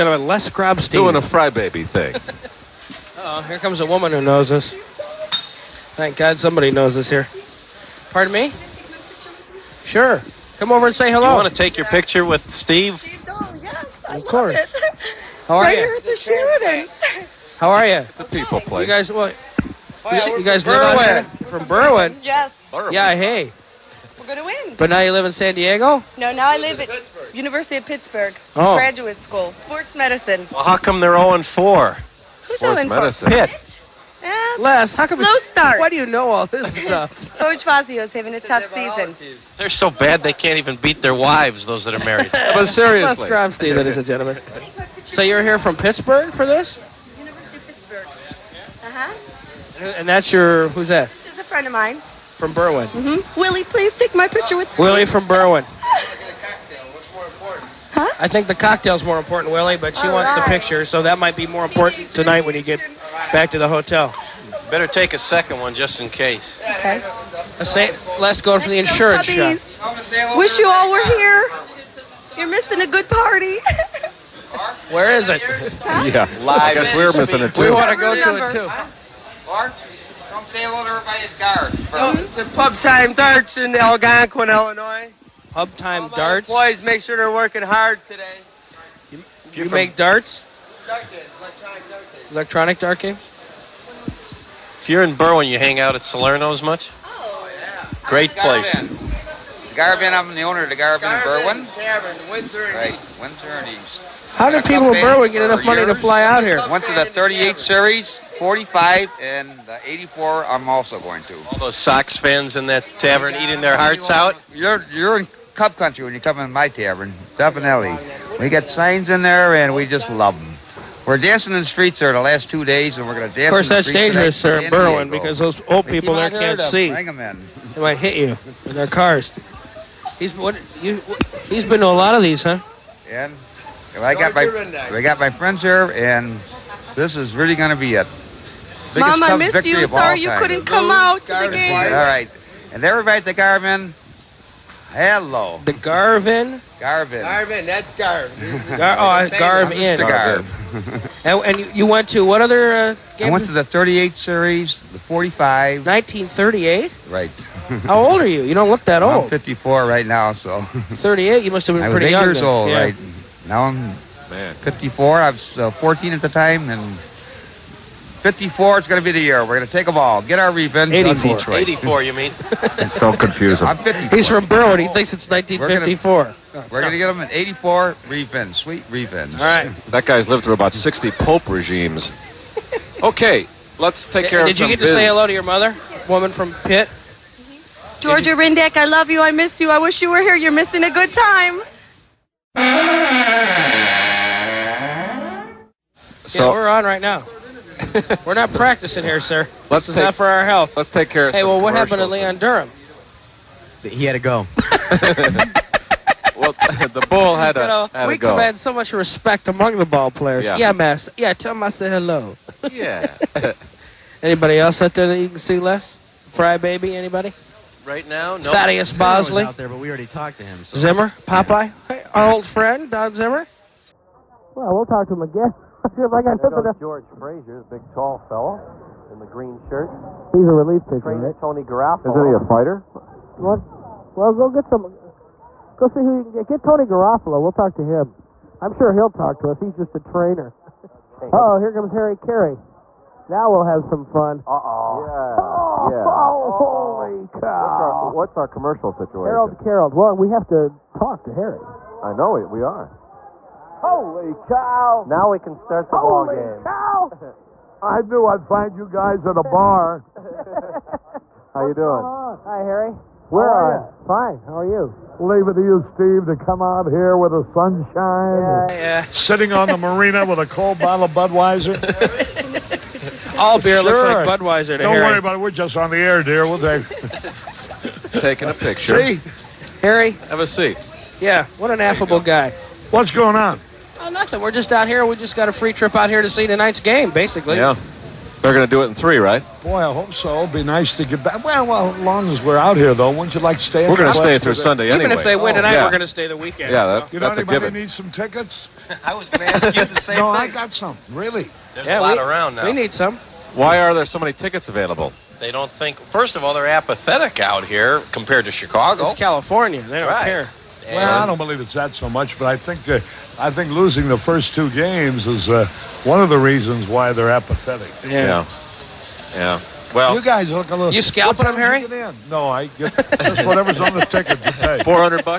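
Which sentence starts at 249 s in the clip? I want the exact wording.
Well, we have to talk to Harry.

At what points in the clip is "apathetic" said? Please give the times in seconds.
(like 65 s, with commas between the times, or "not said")
306 s, 317 s.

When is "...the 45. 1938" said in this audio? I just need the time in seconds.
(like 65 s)
154 s.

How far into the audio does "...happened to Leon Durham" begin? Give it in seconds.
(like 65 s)
201 s.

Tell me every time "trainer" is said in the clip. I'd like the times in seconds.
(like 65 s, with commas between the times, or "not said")
231 s, 240 s.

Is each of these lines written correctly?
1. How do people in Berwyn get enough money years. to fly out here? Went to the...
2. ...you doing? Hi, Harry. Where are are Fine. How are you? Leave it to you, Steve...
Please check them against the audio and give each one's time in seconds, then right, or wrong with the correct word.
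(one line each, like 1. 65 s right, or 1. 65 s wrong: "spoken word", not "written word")
1. 104 s right
2. 261 s right.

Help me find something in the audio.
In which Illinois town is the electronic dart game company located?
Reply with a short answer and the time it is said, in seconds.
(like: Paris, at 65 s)
Algonquin, at 83 s.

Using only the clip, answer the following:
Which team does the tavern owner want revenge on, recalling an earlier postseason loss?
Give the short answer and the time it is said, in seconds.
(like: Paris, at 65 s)
Detroit, at 171 s.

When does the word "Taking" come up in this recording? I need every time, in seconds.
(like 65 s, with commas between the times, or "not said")
278 s.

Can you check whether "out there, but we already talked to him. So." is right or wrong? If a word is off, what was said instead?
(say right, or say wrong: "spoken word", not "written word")
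right.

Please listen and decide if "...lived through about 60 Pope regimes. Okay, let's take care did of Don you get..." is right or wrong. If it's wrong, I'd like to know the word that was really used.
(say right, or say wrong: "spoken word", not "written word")
wrong: "Did", not "Don".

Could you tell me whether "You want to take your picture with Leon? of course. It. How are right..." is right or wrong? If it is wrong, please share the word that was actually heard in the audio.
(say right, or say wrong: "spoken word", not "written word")
wrong: "Steve", not "Leon".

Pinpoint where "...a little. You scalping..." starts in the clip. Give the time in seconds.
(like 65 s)
320 s.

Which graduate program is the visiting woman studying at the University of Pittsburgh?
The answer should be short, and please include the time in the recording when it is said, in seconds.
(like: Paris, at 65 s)
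Sports medicine, at 29 s.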